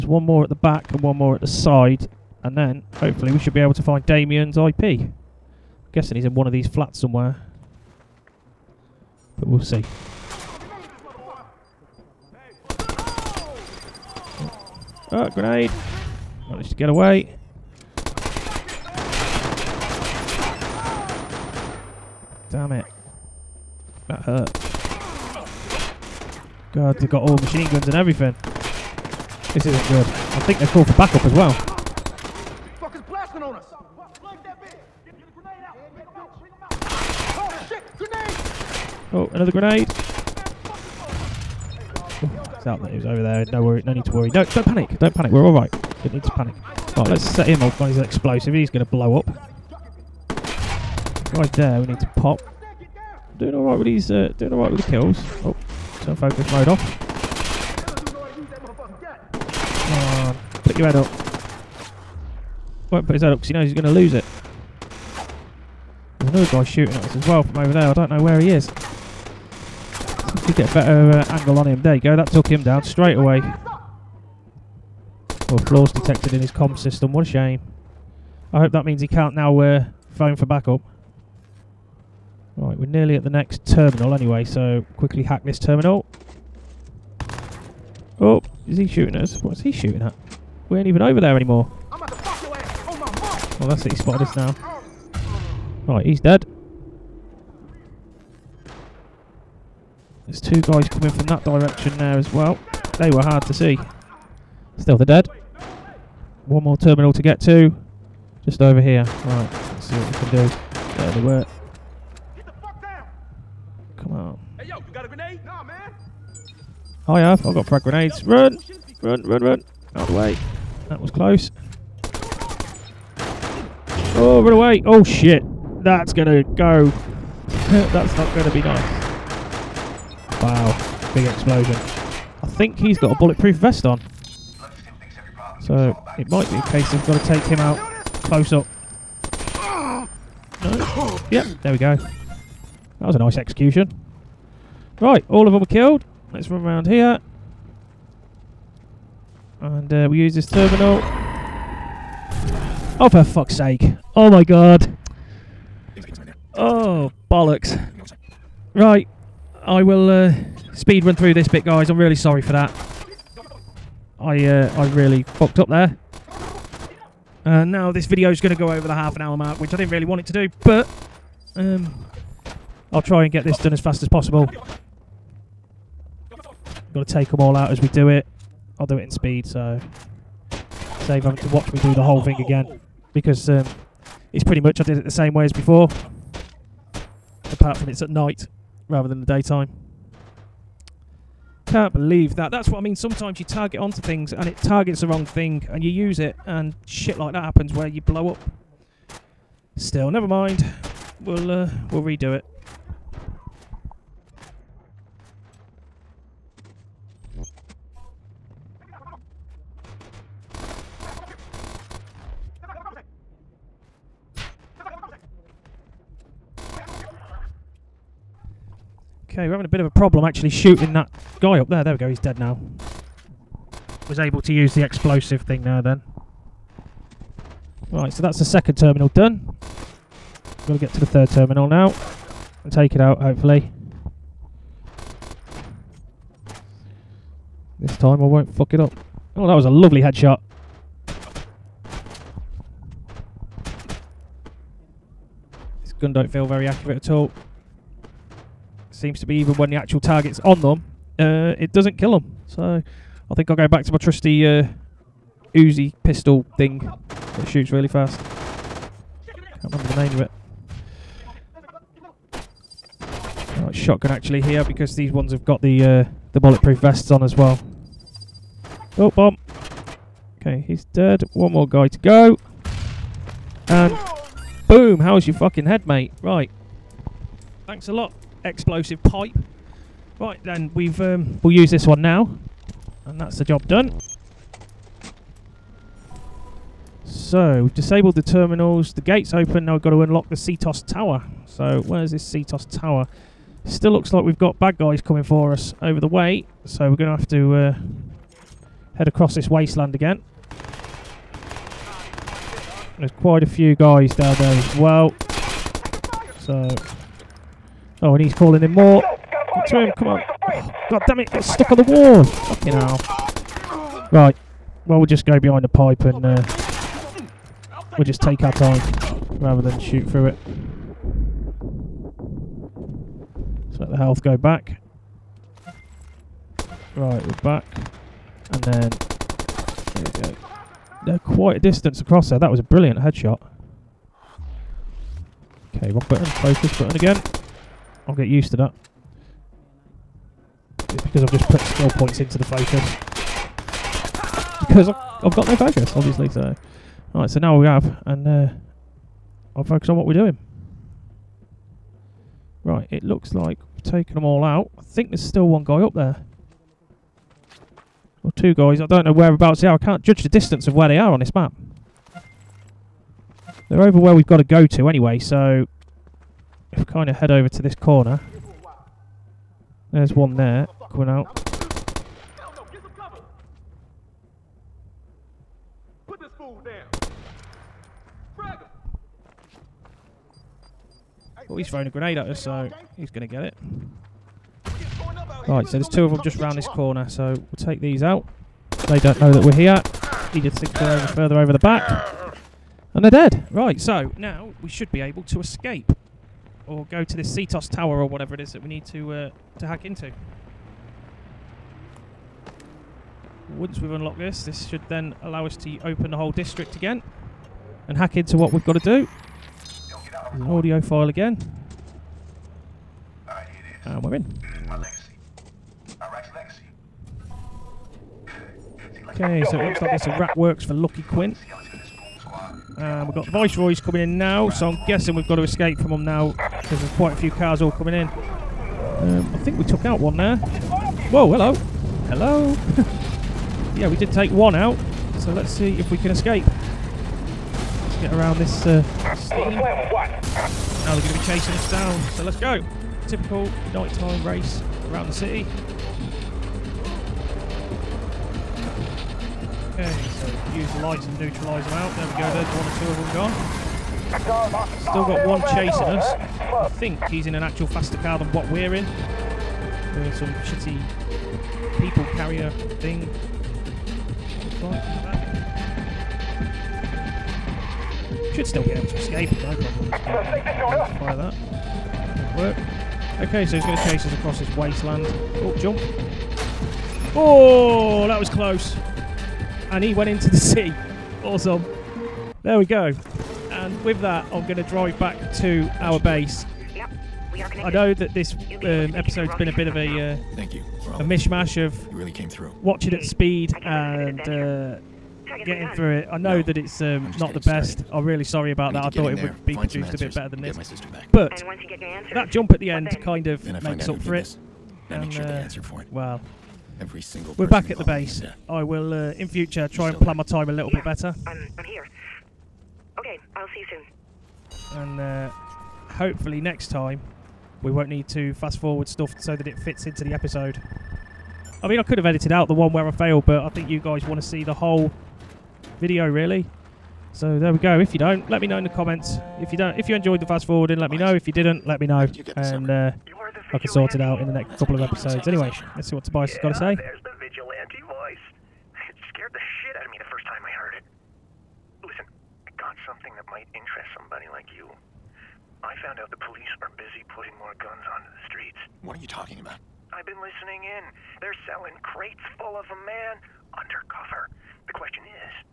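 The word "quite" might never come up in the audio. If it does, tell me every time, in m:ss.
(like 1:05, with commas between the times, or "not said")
5:03, 5:31, 7:06.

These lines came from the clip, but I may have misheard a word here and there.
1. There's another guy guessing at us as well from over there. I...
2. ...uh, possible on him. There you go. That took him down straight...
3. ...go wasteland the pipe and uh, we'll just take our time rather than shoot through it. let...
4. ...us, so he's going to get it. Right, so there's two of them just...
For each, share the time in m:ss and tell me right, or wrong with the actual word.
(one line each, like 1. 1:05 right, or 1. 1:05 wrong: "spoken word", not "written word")
1. 1:06 wrong: "shooting", not "guessing"
2. 1:11 wrong: "angle", not "possible"
3. 5:15 wrong: "behind", not "wasteland"
4. 6:22 right.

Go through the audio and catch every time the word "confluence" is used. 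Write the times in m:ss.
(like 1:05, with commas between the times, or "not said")
not said.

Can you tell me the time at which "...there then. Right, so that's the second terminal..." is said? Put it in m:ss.
3:45.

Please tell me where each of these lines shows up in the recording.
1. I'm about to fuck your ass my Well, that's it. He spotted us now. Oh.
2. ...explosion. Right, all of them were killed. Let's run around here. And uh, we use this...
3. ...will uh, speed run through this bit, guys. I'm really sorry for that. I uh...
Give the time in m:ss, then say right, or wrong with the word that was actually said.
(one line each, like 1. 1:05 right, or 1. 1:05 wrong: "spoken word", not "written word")
1. 1:31 right
2. 2:23 wrong: "execution", not "explosion"
3. 2:39 right.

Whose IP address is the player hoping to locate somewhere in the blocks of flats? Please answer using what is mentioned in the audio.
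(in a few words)
Damien.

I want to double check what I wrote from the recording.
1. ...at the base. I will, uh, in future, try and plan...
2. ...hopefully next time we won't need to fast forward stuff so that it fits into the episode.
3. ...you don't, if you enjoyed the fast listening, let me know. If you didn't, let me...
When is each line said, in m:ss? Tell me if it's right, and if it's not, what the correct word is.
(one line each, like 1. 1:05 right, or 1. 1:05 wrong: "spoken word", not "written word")
1. 8:27 right
2. 8:35 right
3. 8:49 wrong: "forwarding", not "listening".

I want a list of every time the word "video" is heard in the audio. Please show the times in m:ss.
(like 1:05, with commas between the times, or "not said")
2:48, 8:45.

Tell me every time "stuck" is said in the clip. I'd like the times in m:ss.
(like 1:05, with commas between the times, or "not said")
5:11.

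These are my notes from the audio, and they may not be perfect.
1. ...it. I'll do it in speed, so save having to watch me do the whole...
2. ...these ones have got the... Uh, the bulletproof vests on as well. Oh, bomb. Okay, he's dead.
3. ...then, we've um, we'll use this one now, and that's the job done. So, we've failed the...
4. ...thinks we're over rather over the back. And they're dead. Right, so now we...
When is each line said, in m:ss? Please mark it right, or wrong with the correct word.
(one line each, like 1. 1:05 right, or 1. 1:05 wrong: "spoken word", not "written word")
1. 2:58 right
2. 4:24 right
3. 4:40 wrong: "disabled", not "failed"
4. 6:30 wrong: "further", not "rather".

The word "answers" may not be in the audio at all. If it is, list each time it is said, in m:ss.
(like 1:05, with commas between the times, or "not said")
8:21, 8:25.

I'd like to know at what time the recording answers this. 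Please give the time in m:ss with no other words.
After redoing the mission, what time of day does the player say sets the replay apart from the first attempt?
3:08.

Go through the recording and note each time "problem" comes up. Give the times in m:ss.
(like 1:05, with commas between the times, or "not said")
3:39, 7:49.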